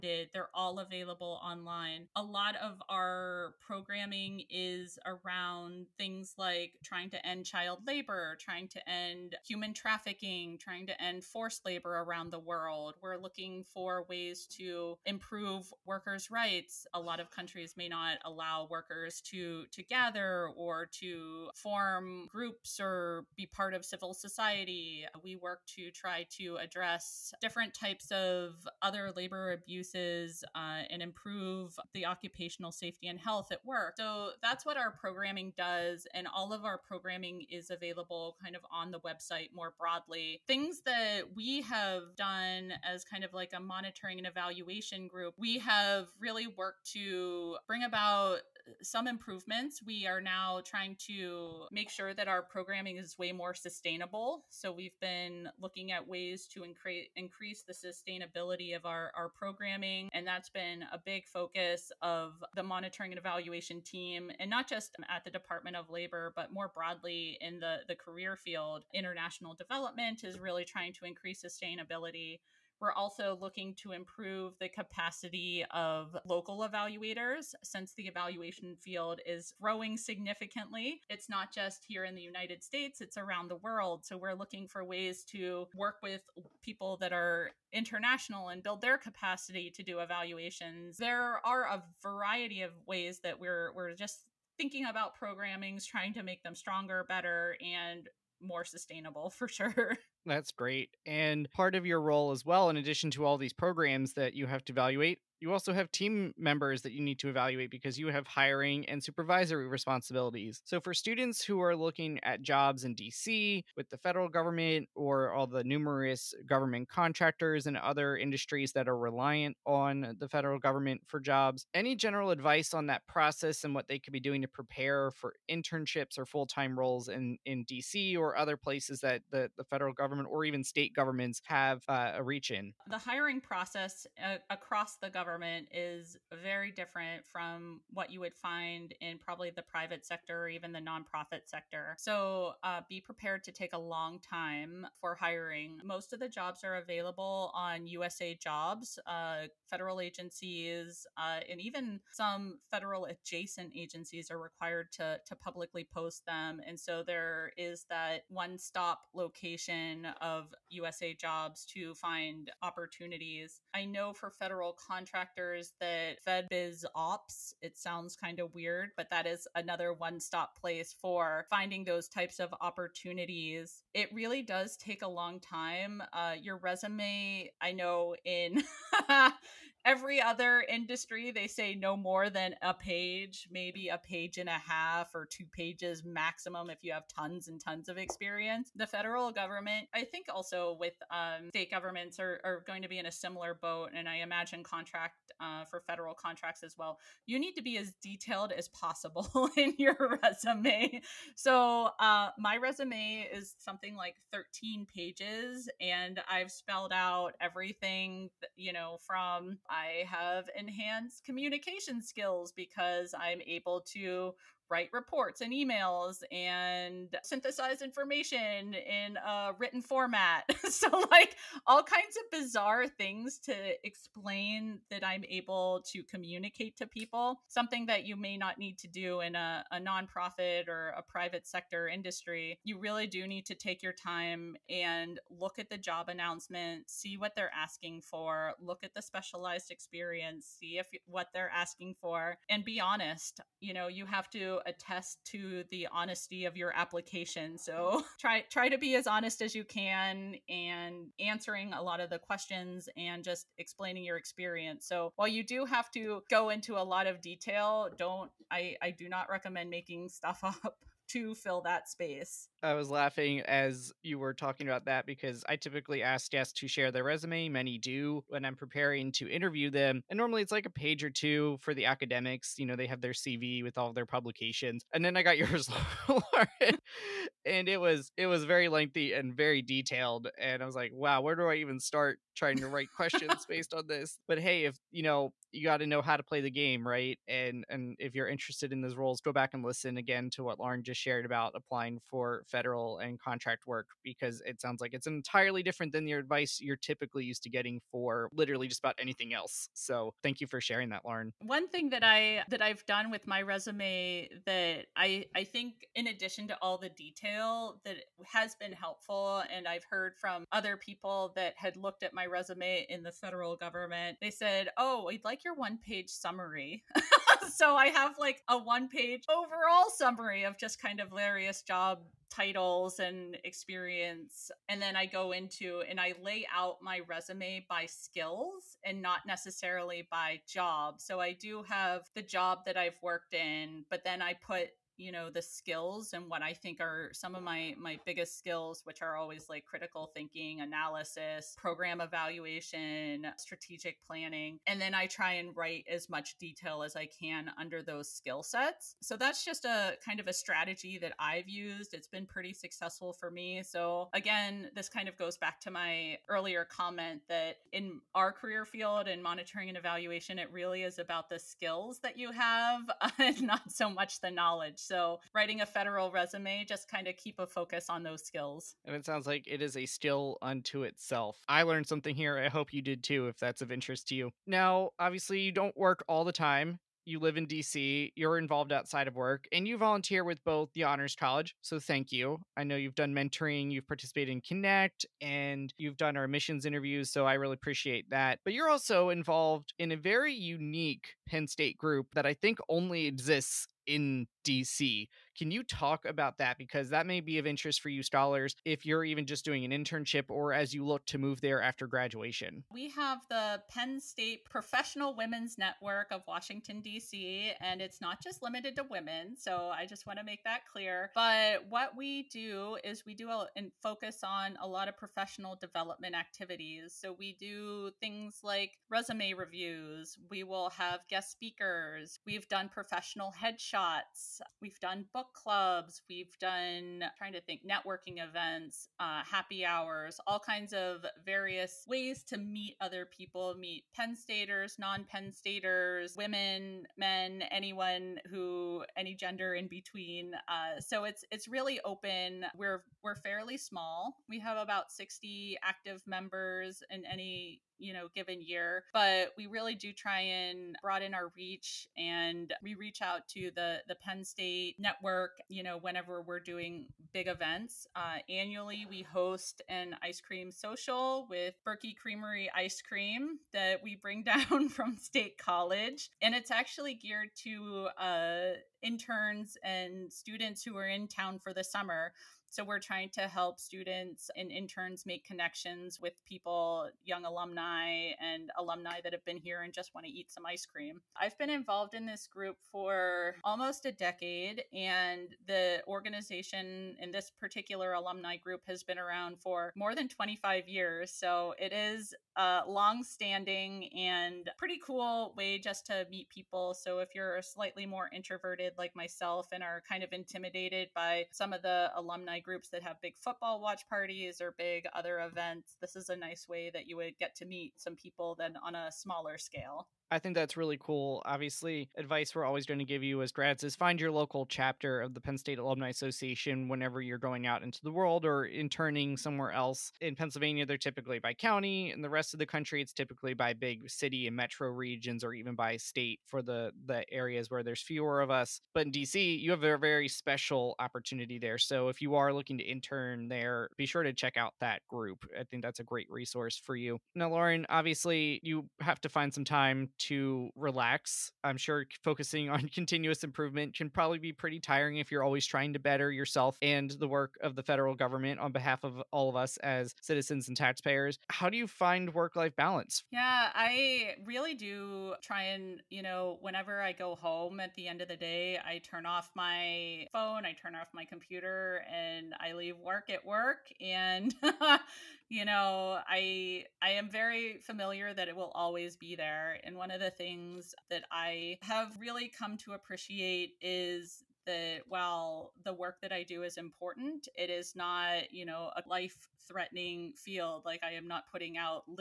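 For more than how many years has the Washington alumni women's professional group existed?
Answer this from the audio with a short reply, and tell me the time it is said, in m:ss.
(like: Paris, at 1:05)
25 years, at 8:10.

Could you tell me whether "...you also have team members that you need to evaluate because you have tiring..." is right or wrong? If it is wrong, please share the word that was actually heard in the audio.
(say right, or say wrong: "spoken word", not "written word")
wrong: "hiring", not "tiring".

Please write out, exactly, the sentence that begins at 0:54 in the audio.
So we've been looking at ways to incre- increase the sustainability of our, our programming.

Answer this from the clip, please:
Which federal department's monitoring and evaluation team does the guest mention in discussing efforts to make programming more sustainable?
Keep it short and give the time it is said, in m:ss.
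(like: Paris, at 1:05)
Department of Labor, at 1:05.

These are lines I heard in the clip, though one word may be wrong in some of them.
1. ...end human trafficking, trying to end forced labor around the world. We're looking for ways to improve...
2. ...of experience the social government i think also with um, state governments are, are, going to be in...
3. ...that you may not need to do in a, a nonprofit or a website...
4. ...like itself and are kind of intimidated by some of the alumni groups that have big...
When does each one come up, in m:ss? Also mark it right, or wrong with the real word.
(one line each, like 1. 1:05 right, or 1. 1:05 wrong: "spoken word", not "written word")
1. 0:08 right
2. 3:07 wrong: "federal", not "social"
3. 3:47 wrong: "private", not "website"
4. 8:18 wrong: "myself", not "itself".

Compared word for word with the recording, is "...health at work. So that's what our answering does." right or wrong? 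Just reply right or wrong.
wrong.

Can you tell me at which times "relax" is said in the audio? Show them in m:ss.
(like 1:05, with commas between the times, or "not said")
9:00.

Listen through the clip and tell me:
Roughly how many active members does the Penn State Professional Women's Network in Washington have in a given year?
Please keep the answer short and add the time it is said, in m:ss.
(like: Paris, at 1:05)
60, at 7:24.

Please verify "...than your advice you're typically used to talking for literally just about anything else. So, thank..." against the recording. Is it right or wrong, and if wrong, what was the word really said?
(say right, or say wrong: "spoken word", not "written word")
wrong: "getting", not "talking".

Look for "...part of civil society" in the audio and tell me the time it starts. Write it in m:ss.
0:23.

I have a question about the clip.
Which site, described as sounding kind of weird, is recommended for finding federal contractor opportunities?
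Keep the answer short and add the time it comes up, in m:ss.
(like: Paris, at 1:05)
biz Ops, at 2:46.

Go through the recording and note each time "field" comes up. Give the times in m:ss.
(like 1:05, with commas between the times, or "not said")
1:08, 1:18, 5:58, 9:40.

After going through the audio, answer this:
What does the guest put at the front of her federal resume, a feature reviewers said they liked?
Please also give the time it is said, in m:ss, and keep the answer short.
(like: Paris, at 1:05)
one page summary, at 5:15.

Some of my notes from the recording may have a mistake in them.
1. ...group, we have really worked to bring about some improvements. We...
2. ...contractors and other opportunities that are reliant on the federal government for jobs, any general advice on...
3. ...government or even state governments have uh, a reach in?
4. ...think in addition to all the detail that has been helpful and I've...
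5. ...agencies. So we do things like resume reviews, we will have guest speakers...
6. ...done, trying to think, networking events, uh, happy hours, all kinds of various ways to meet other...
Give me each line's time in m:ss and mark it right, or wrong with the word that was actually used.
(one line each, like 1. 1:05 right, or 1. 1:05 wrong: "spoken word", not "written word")
1. 0:45 right
2. 1:56 wrong: "industries", not "opportunities"
3. 2:09 right
4. 5:05 right
5. 6:56 wrong: "activities", not "agencies"
6. 7:06 right.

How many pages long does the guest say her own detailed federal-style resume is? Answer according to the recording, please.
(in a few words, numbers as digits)
13.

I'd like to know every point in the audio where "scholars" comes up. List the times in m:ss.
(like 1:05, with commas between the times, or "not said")
6:38.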